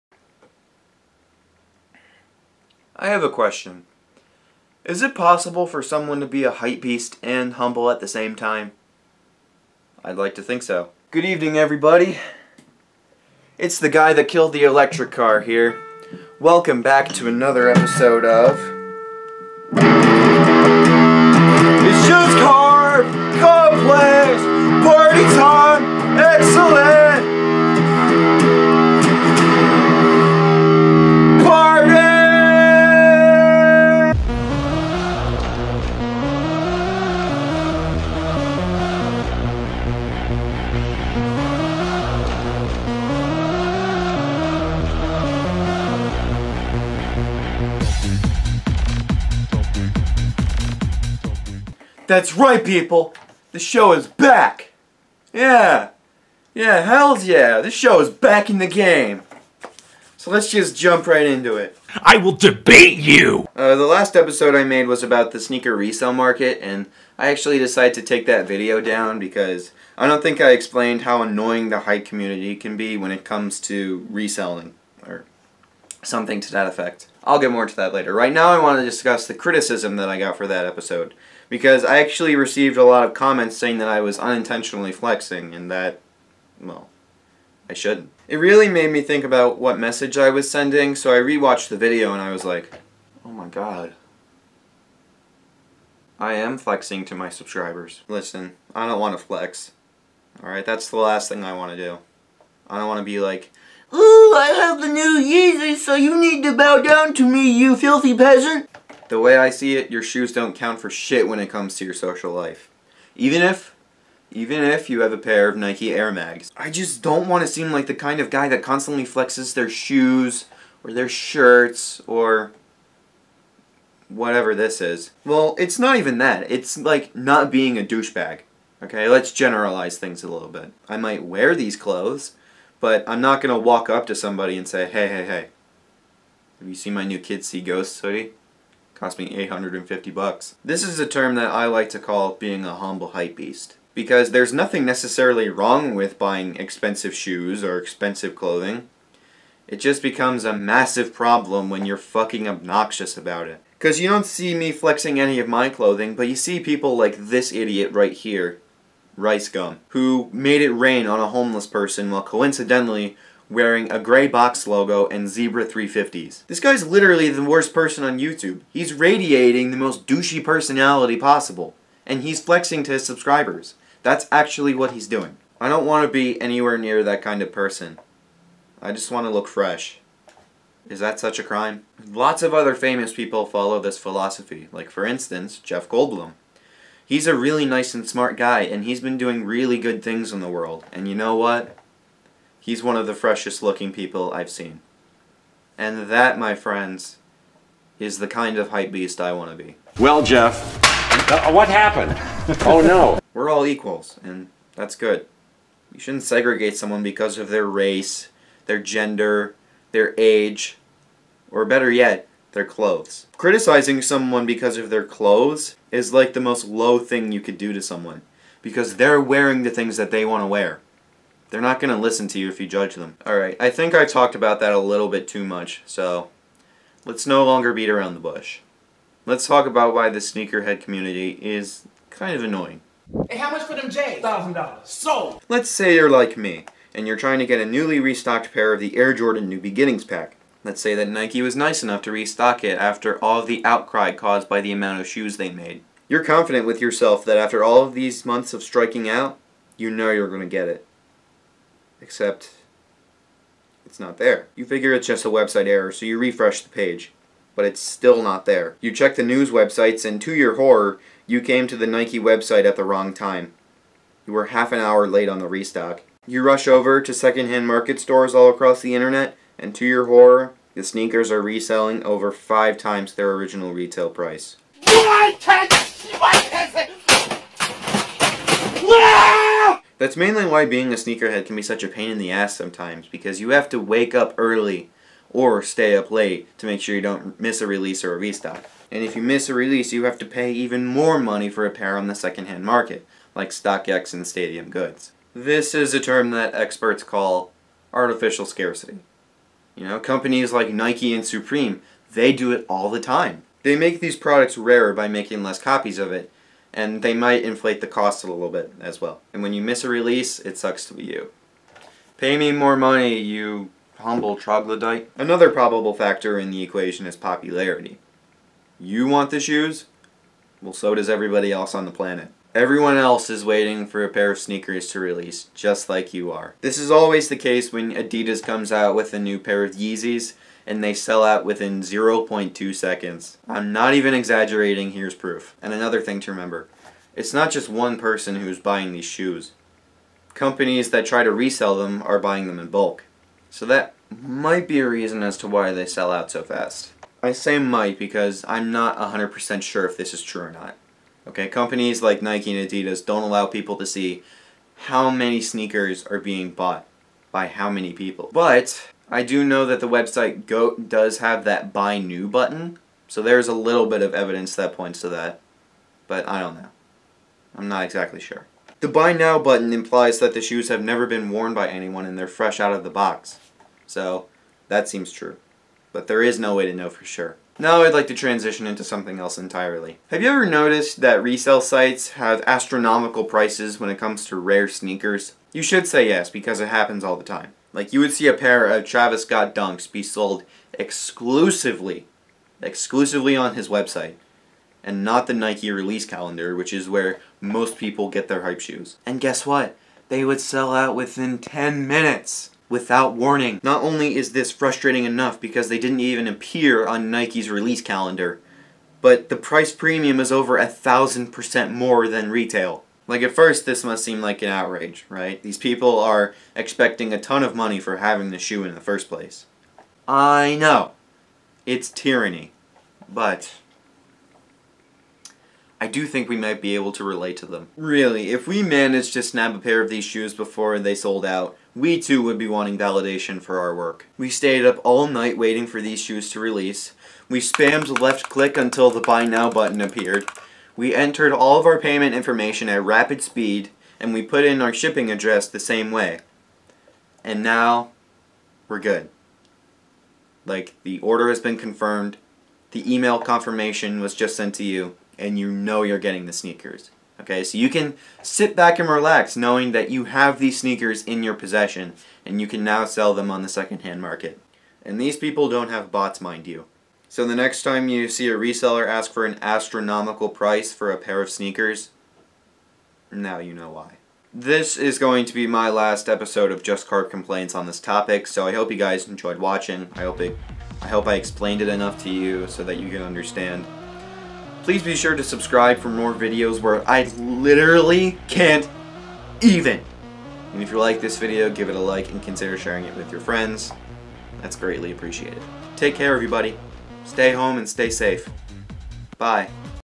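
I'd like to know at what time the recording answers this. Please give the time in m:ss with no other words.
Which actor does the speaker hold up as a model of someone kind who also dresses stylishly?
3:05.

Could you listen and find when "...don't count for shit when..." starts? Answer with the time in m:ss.
1:50.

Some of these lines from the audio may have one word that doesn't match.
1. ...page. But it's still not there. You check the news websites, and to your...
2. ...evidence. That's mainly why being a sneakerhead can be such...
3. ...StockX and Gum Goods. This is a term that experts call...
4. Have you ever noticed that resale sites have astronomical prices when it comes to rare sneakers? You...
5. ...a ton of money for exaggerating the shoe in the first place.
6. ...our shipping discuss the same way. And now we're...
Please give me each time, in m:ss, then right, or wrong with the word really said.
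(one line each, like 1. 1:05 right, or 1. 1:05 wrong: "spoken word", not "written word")
1. 4:16 right
2. 4:34 wrong: "price", not "evidence"
3. 4:53 wrong: "Stadium", not "Gum"
4. 6:20 right
5. 6:57 wrong: "having", not "exaggerating"
6. 7:24 wrong: "address", not "discuss".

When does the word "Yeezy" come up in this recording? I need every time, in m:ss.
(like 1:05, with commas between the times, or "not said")
1:45, 5:29.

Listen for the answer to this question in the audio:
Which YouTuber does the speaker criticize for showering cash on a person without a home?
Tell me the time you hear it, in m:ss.
2:39.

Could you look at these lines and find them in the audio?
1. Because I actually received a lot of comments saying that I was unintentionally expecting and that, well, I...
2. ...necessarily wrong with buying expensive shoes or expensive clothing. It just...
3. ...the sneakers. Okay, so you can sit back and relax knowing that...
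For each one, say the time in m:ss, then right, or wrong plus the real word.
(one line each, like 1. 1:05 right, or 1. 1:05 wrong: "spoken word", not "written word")
1. 1:21 wrong: "flexing", not "expecting"
2. 2:24 right
3. 7:36 right.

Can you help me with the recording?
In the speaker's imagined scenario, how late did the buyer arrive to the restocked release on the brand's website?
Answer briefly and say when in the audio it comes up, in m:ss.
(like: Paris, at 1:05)
half an hour, at 4:24.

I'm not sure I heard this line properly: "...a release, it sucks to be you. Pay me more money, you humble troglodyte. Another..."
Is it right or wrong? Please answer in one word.
right.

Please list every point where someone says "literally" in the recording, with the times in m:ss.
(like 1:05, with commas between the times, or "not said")
2:46, 8:07.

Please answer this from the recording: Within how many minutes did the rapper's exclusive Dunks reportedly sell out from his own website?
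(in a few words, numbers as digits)
10 minutes.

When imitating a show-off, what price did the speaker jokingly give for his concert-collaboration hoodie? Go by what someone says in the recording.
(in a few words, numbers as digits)
$850.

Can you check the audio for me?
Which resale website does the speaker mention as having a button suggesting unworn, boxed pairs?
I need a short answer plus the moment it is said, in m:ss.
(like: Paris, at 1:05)
GOAT, at 6:00.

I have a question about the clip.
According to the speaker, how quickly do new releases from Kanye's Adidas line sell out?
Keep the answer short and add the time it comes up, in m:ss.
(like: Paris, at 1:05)
0.2 seconds, at 5:31.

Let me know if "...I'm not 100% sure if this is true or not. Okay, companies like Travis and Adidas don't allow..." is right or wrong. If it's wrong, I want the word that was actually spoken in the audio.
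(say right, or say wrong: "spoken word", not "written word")
wrong: "Nike", not "Travis".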